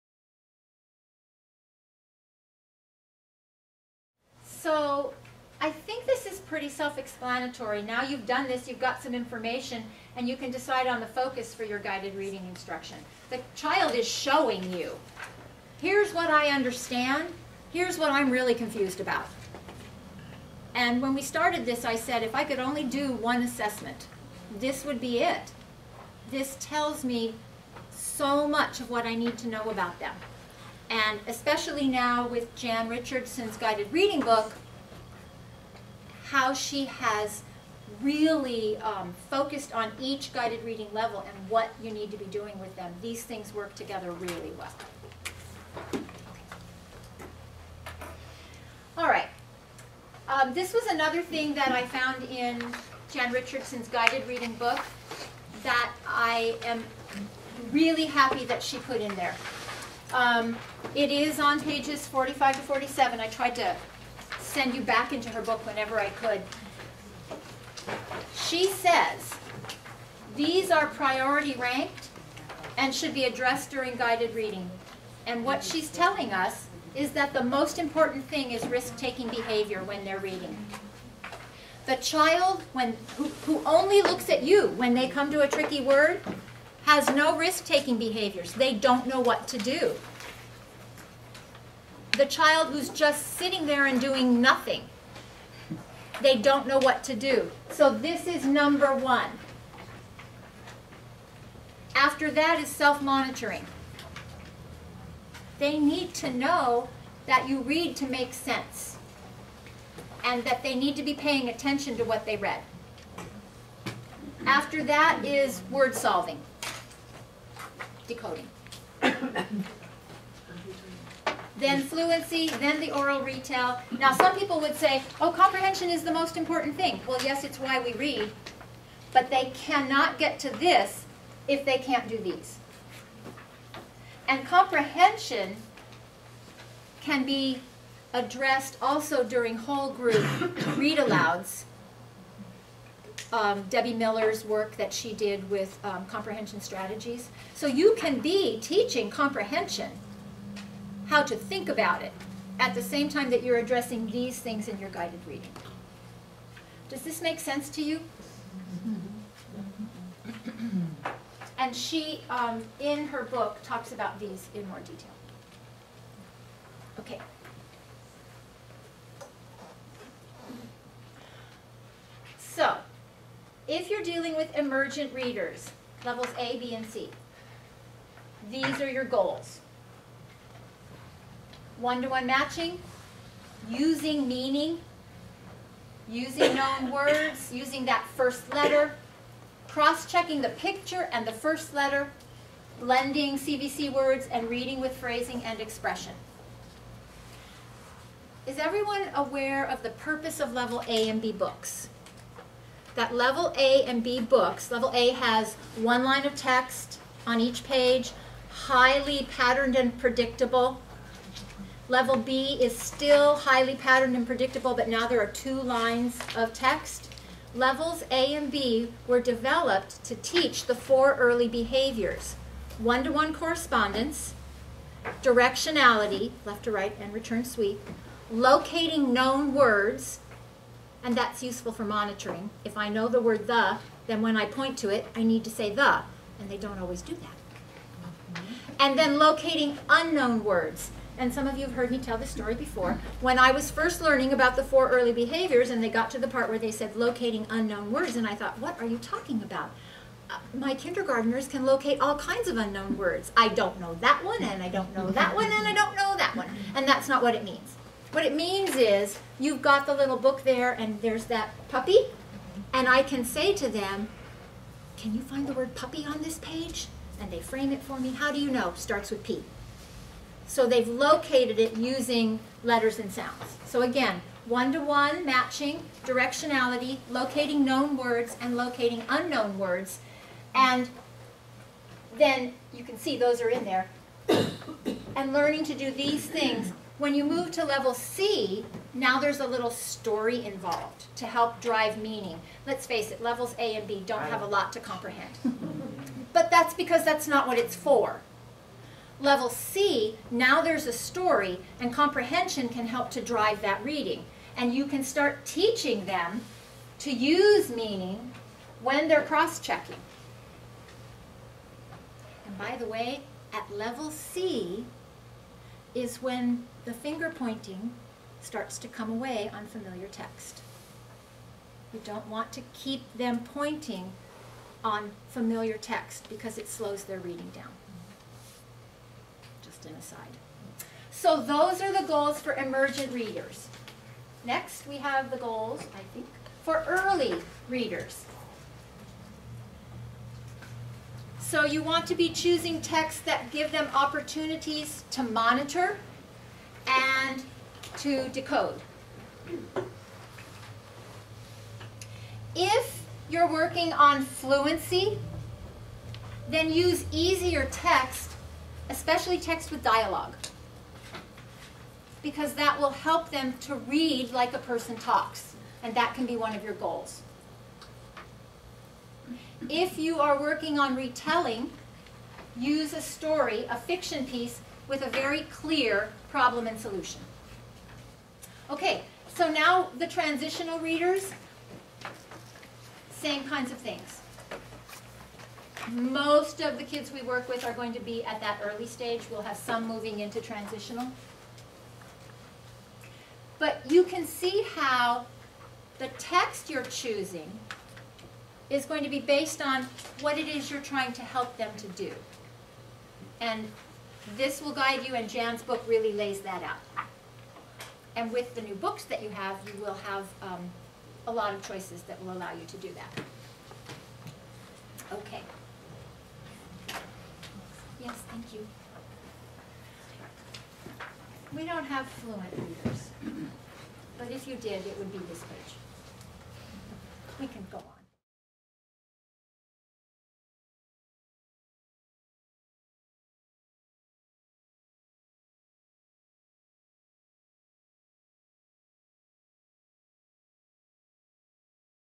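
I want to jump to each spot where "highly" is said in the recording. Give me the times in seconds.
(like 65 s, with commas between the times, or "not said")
208 s, 213 s.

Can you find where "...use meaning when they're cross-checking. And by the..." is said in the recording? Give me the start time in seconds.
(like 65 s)
307 s.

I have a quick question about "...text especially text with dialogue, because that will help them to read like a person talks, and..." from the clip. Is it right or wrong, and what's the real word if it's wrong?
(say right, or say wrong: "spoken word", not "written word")
right.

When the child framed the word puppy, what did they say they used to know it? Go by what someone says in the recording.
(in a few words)
Starts with P.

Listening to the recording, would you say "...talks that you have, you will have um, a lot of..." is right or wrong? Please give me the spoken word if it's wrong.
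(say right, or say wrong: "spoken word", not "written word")
wrong: "books", not "talks".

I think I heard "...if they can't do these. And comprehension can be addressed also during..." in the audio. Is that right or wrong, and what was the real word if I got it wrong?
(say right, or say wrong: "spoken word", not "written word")
right.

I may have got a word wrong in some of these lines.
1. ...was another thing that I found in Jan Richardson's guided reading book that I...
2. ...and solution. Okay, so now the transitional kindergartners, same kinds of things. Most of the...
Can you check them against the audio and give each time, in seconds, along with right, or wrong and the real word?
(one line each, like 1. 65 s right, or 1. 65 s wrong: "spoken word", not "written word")
1. 50 s right
2. 376 s wrong: "readers", not "kindergartners".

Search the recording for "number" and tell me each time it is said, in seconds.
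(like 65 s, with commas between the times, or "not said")
98 s.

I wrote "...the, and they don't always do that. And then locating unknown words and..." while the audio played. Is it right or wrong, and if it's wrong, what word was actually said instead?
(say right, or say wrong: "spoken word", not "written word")
right.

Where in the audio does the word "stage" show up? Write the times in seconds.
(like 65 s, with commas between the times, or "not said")
388 s.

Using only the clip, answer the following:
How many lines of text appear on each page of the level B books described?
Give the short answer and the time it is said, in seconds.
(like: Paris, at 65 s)
2, at 215 s.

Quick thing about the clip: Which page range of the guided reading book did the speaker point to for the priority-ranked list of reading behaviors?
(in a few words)
45 to 47.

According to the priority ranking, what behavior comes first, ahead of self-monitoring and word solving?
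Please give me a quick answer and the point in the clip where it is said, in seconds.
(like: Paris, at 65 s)
Risk-taking behavior, at 78 s.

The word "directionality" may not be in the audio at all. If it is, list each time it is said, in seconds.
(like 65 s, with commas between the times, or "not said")
225 s, 276 s.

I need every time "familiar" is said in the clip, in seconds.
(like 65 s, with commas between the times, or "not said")
319 s, 325 s.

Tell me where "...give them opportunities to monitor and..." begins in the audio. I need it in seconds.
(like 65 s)
343 s.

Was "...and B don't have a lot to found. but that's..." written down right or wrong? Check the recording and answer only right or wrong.
wrong.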